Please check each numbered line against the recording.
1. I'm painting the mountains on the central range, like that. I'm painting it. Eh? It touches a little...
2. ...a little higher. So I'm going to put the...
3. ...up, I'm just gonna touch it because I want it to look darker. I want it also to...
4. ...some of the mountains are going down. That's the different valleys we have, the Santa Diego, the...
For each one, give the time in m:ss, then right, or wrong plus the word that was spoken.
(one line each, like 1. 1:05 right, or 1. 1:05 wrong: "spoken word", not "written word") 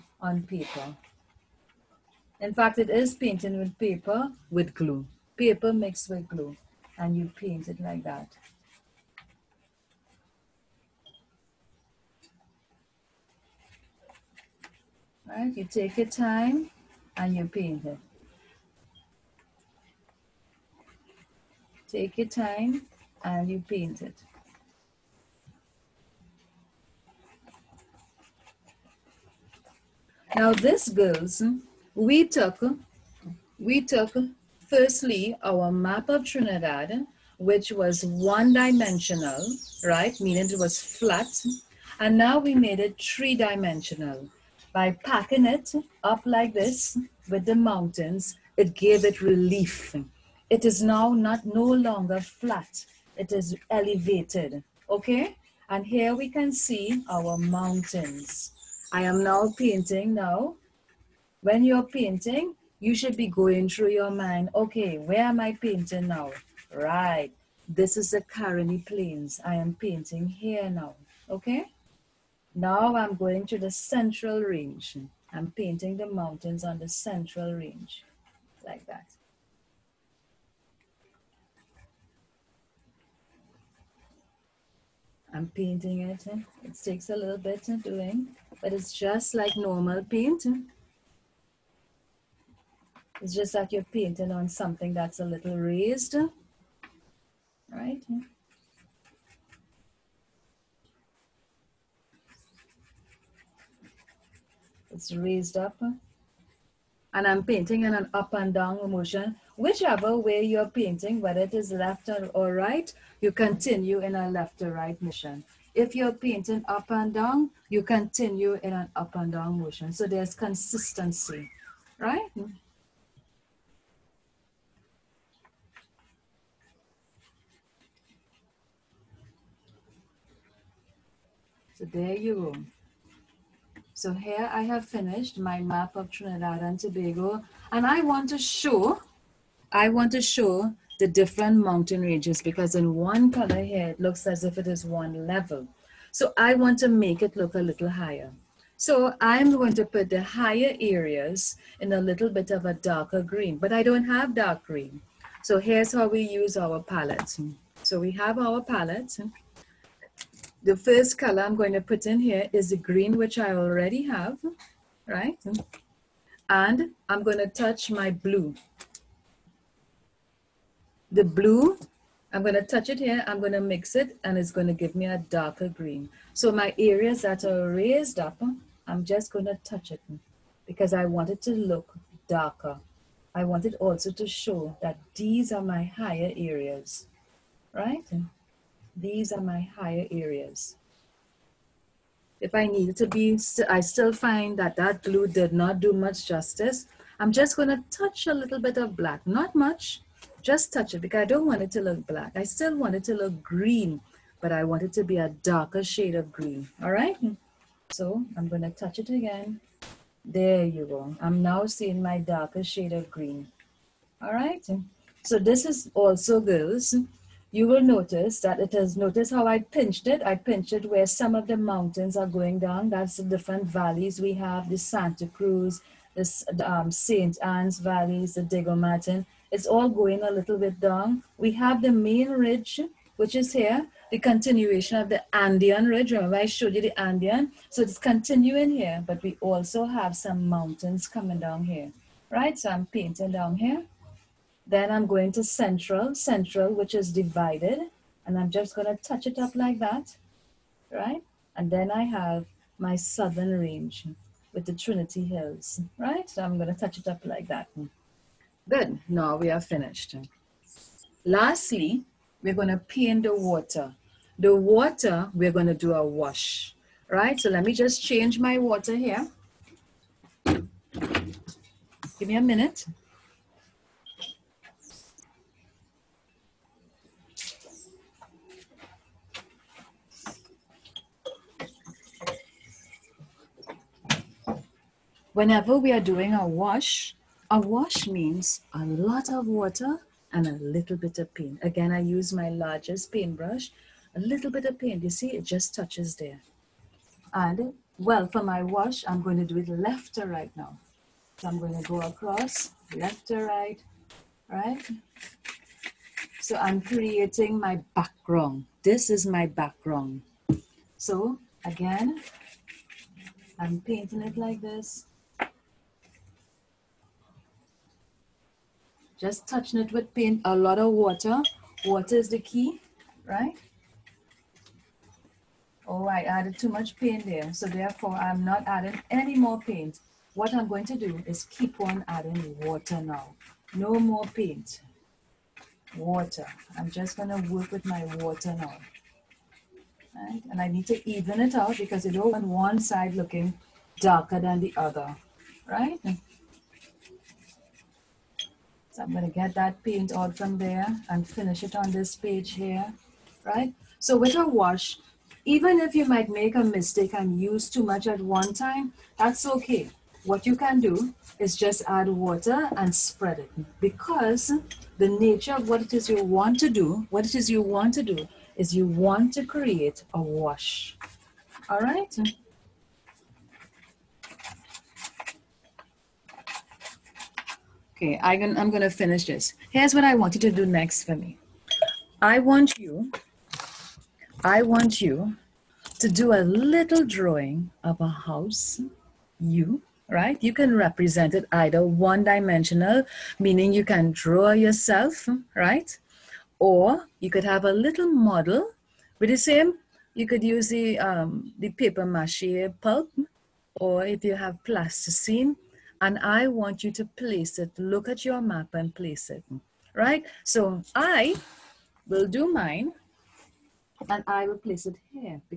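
1. 1:15 wrong: "takes", not "touches"
2. 2:27 right
3. 2:58 right
4. 3:41 wrong: "Cruz", not "Diego".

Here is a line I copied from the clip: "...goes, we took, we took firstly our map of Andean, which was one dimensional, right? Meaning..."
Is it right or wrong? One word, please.
wrong.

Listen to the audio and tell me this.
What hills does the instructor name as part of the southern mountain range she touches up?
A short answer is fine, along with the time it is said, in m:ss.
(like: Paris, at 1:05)
Trinity Hills, at 4:14.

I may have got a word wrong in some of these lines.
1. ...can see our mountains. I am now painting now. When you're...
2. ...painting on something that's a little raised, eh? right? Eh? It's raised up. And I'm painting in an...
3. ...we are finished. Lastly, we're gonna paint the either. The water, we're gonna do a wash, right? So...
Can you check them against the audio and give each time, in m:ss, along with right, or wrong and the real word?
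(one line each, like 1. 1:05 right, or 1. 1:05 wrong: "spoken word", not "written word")
1. 0:56 right
2. 1:33 right
3. 4:19 wrong: "water", not "either".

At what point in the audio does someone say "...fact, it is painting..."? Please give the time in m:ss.
0:02.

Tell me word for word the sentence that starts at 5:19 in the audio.
Just touching it with paint, a lot of water.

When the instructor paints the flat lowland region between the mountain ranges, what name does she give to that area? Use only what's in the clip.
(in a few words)
Caroni Plains.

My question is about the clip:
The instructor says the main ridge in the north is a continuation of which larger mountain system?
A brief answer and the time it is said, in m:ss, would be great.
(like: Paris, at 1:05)
Andean ridge, at 3:55.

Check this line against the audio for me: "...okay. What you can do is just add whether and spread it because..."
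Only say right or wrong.
wrong.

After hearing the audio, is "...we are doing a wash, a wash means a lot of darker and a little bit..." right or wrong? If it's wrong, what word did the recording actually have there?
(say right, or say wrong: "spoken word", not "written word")
wrong: "water", not "darker".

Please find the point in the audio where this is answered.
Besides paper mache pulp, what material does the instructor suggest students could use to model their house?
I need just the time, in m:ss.
6:44.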